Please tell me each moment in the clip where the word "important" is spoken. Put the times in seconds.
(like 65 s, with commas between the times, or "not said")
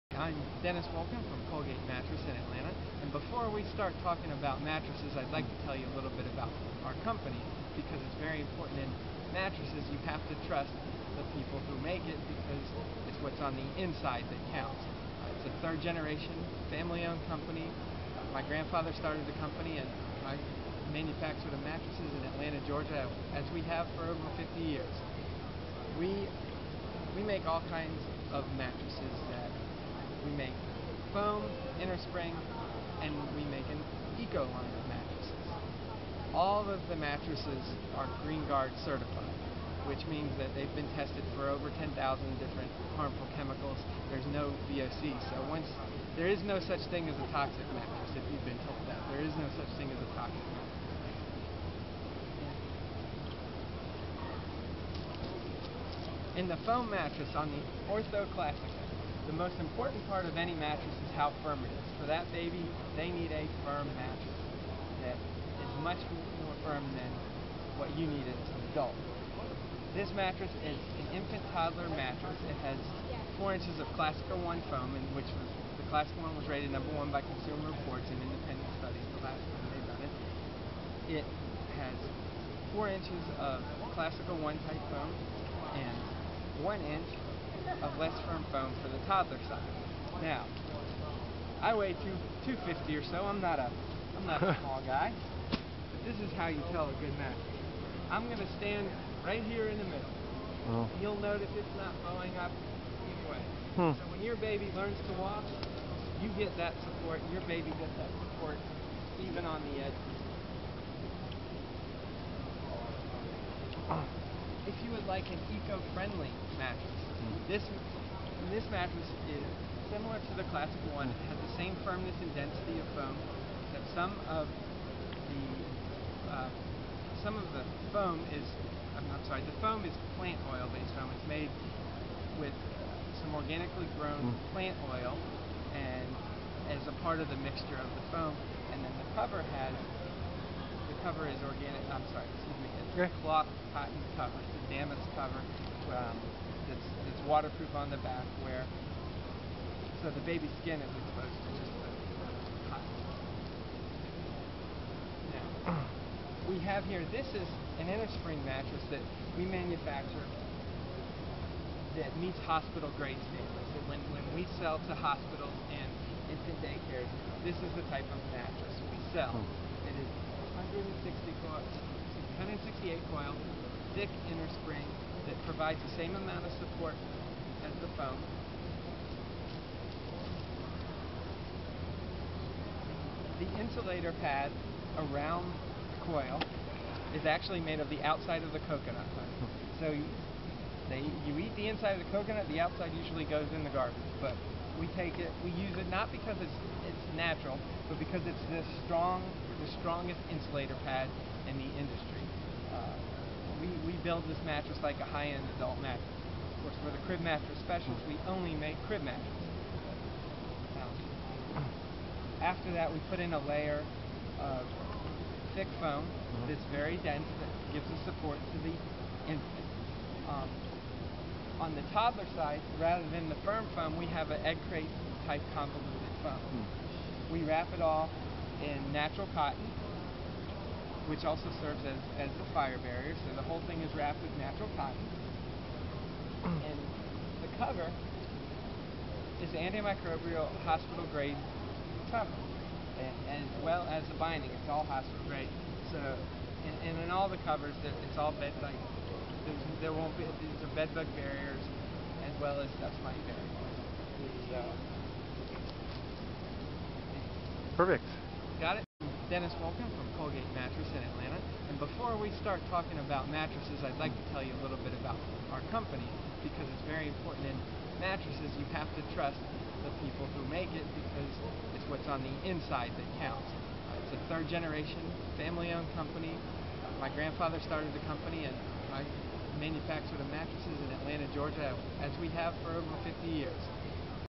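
8 s, 59 s, 267 s.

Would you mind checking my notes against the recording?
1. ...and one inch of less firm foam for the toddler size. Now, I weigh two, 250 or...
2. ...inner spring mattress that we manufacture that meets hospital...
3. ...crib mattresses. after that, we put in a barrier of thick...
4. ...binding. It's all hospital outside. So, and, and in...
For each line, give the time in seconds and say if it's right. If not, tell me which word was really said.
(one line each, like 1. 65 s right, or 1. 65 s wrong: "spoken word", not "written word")
1. 85 s right
2. 157 s right
3. 208 s wrong: "layer", not "barrier"
4. 244 s wrong: "grade", not "outside".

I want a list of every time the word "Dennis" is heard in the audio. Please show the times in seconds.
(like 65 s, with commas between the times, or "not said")
0 s, 259 s.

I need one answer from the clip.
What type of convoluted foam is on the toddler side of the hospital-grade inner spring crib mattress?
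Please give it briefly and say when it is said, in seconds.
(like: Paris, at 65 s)
Egg crate, at 224 s.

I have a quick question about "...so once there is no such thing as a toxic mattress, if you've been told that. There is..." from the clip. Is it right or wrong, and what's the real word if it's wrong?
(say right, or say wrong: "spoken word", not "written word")
right.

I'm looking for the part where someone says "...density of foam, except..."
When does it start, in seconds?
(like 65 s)
122 s.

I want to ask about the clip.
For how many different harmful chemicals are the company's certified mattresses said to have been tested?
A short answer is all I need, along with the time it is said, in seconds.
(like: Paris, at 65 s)
10,000, at 41 s.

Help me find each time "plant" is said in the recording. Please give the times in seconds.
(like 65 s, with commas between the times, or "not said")
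130 s, 134 s.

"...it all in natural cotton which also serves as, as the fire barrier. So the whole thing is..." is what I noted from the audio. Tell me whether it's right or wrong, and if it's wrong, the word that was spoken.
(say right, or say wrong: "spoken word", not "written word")
right.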